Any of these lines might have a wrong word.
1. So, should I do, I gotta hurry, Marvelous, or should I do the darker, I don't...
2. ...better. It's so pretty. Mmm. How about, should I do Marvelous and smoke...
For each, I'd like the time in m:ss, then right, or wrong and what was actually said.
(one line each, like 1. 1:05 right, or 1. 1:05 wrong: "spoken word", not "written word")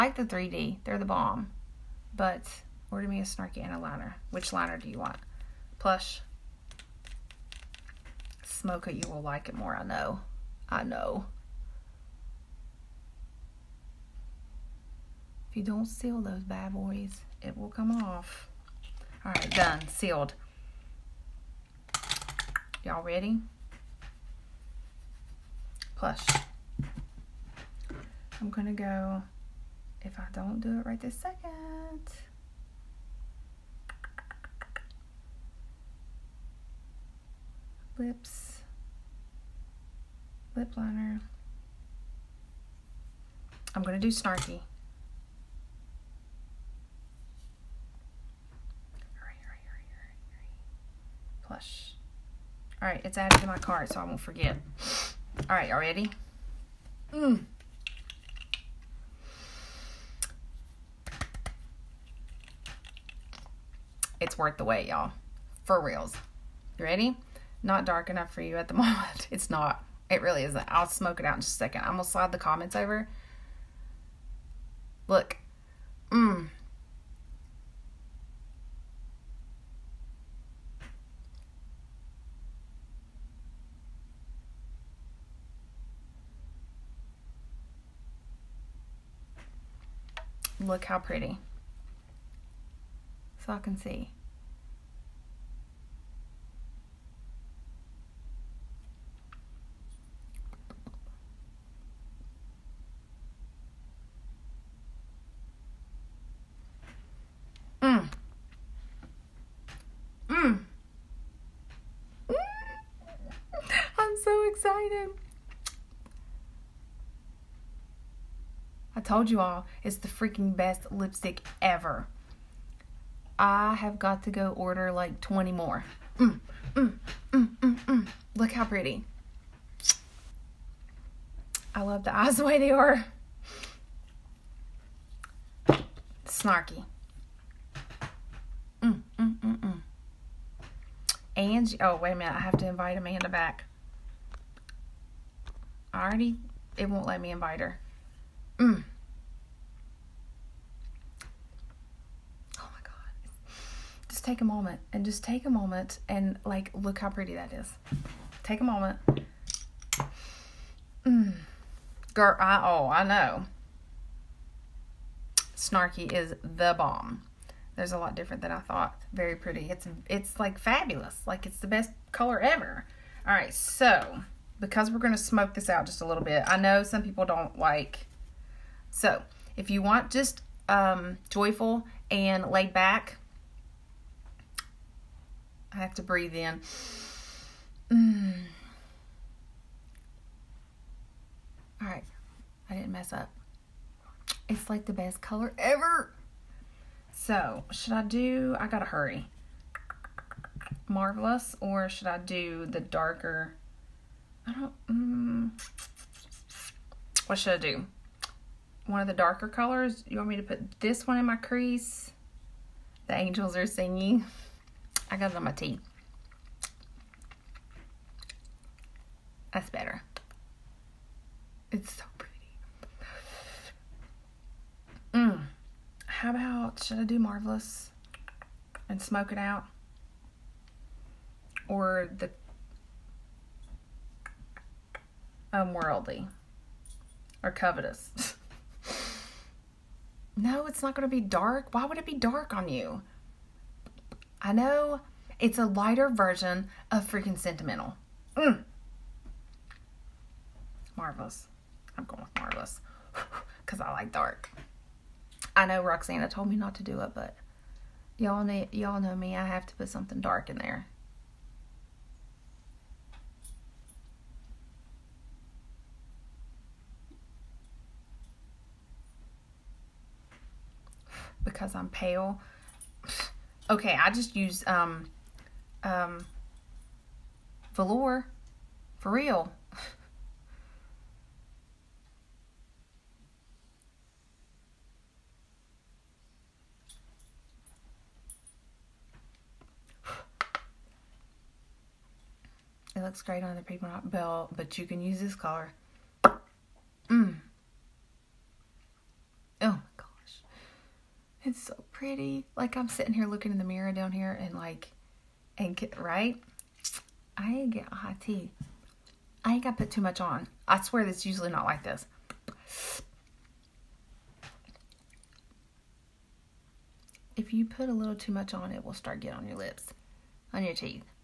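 1. 3:17 right
2. 3:39 right.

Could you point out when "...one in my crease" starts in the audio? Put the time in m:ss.
3:31.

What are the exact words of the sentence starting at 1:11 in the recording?
I'm going to slide the comments over.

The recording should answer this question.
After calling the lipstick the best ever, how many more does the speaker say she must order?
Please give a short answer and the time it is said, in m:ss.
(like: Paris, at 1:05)
20, at 2:05.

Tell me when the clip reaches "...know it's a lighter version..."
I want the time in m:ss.
4:04.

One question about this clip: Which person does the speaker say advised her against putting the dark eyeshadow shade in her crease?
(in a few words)
Roxana.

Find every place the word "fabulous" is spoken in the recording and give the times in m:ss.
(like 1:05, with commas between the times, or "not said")
2:50.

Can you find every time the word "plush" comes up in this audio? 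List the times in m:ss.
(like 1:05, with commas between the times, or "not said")
0:05, 0:25, 0:51.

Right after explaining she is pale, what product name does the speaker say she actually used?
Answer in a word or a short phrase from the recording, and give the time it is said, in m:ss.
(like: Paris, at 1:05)
velour, at 4:37.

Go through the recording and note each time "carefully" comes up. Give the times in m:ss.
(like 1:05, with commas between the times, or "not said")
not said.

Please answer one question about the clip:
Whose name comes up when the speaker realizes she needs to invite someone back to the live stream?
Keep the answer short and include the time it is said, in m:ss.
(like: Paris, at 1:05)
Amanda, at 2:22.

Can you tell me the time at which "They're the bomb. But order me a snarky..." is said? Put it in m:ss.
0:00.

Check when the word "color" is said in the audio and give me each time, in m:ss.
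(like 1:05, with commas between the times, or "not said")
2:52, 3:15, 3:29, 4:55.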